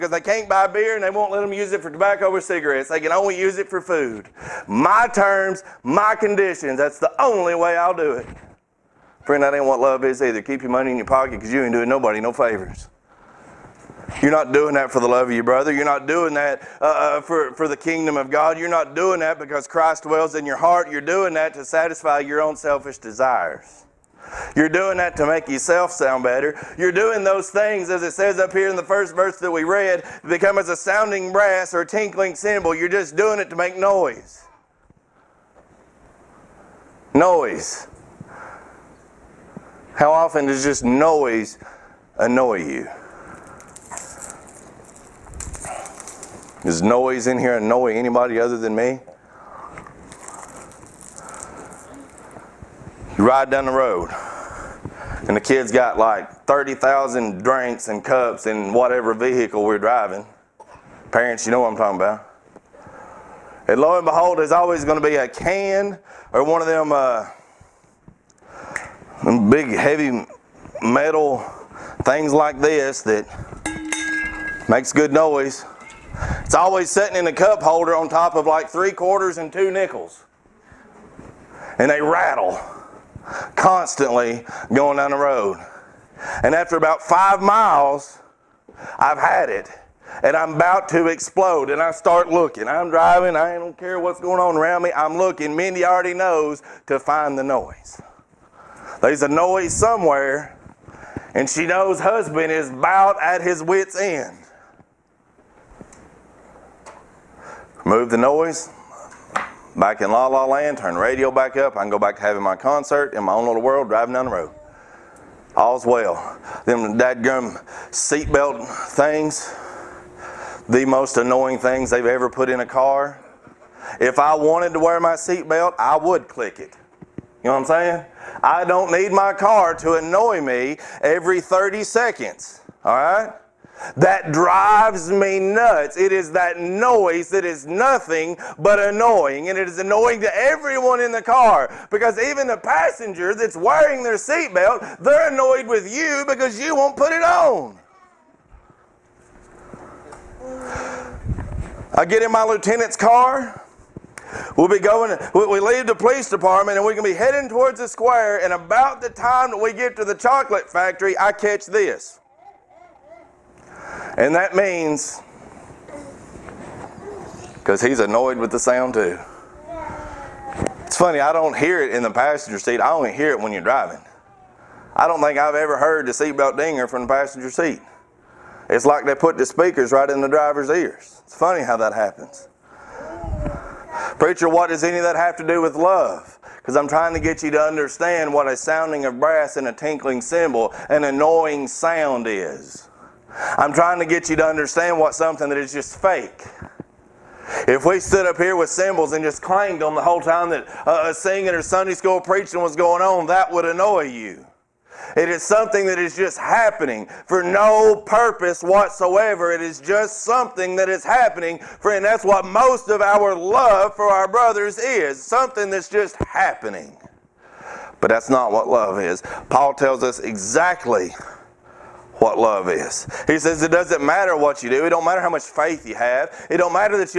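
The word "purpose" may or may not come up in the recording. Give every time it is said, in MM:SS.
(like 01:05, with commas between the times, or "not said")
03:28.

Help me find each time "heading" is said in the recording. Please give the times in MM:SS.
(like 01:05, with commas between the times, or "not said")
02:37.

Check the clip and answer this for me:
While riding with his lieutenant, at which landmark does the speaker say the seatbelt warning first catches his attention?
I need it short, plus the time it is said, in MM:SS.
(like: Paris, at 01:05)
the chocolate factory, at 02:40.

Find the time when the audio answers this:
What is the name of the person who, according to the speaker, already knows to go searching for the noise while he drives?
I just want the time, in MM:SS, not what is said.
01:35.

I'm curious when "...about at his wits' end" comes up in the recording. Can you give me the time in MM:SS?
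01:42.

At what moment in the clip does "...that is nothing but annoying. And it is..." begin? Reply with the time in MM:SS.
02:17.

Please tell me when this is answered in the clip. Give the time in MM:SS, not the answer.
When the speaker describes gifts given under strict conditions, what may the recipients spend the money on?
00:02.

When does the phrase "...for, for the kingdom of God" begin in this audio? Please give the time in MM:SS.
00:17.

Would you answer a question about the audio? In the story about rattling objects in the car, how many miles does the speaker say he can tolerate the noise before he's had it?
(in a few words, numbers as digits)
5.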